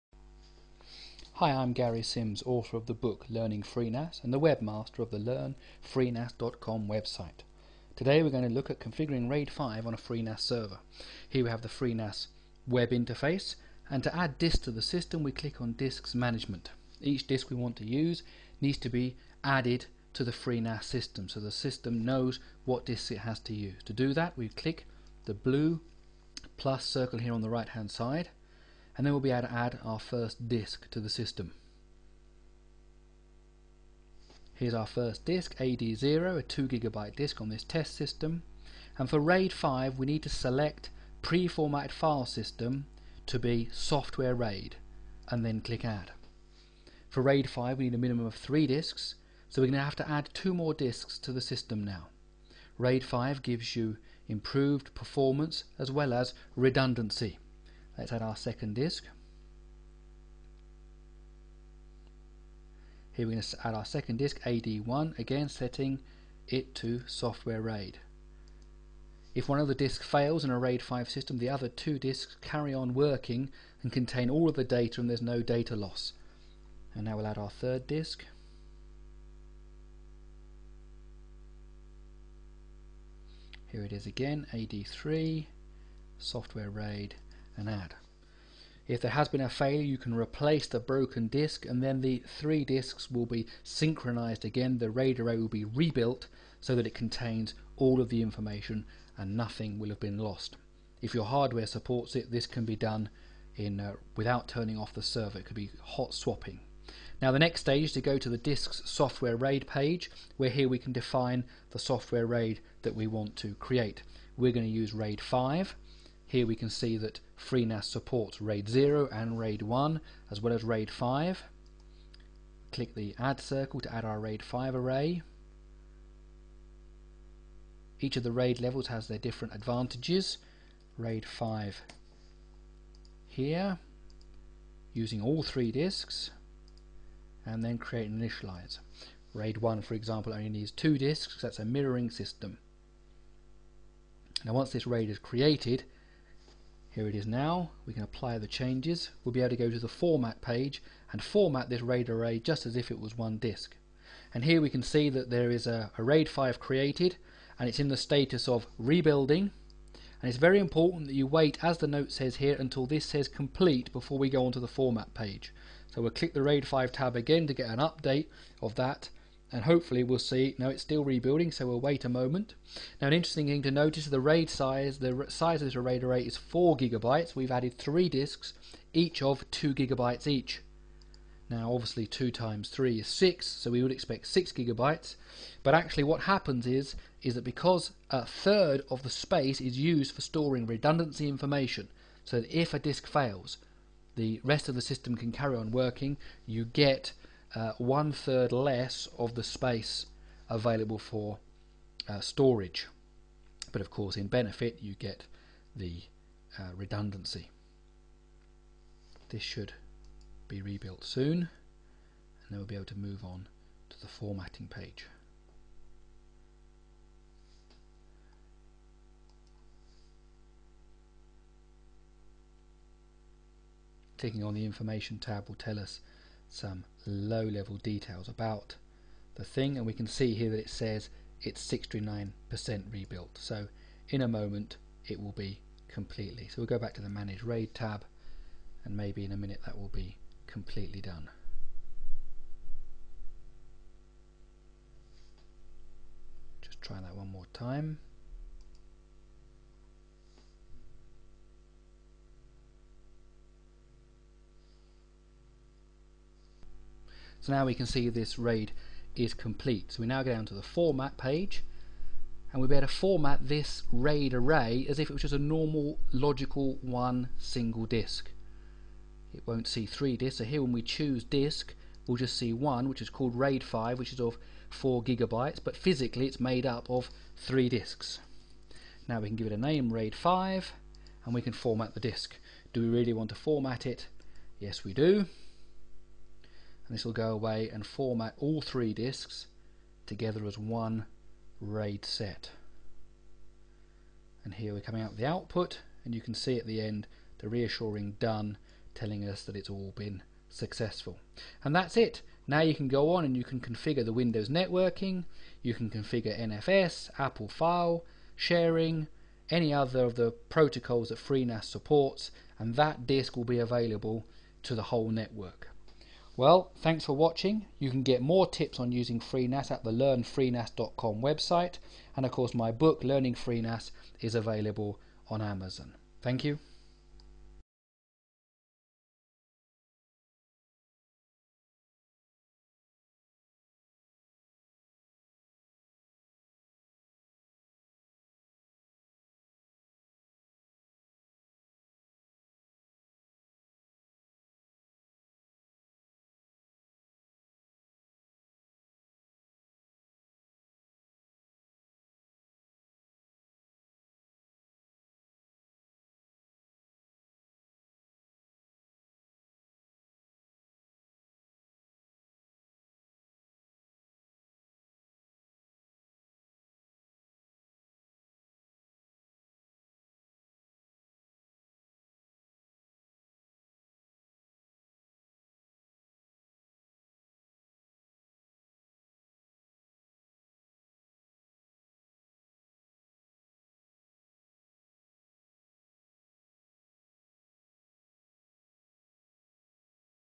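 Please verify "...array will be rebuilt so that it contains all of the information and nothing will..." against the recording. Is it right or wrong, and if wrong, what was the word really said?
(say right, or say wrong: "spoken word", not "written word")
right.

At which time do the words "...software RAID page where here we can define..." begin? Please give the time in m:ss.
1:48.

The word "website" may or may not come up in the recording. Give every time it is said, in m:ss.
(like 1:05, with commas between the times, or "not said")
0:06, 5:21.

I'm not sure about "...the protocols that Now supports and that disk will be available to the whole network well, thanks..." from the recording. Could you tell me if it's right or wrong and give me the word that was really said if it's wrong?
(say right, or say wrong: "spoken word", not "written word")
wrong: "FreeNAS", not "Now".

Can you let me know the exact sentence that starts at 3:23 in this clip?
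But of course, in benefit, you get the uh, redundancy.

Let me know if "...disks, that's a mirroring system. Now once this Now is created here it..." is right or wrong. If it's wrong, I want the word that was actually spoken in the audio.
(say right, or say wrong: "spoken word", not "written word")
wrong: "RAID", not "Now".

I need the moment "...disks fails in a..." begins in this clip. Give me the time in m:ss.
1:09.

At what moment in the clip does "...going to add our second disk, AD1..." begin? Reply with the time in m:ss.
1:03.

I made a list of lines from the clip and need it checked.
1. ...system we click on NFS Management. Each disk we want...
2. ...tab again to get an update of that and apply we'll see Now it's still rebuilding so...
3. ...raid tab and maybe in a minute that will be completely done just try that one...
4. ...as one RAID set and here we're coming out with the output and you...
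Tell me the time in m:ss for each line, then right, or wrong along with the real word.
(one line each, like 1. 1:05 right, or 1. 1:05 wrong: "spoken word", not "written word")
1. 0:14 wrong: "Disks", not "NFS"
2. 2:46 wrong: "hopefully", not "apply"
3. 3:57 right
4. 4:50 right.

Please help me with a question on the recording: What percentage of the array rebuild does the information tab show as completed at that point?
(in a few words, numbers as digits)
69%.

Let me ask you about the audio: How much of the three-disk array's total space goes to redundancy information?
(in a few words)
a third.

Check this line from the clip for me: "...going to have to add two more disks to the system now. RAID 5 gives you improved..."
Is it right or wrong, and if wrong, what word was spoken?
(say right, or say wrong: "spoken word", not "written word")
right.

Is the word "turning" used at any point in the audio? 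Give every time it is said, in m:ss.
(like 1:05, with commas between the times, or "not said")
1:44.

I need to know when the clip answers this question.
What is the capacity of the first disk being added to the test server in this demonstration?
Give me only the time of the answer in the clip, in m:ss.
0:36.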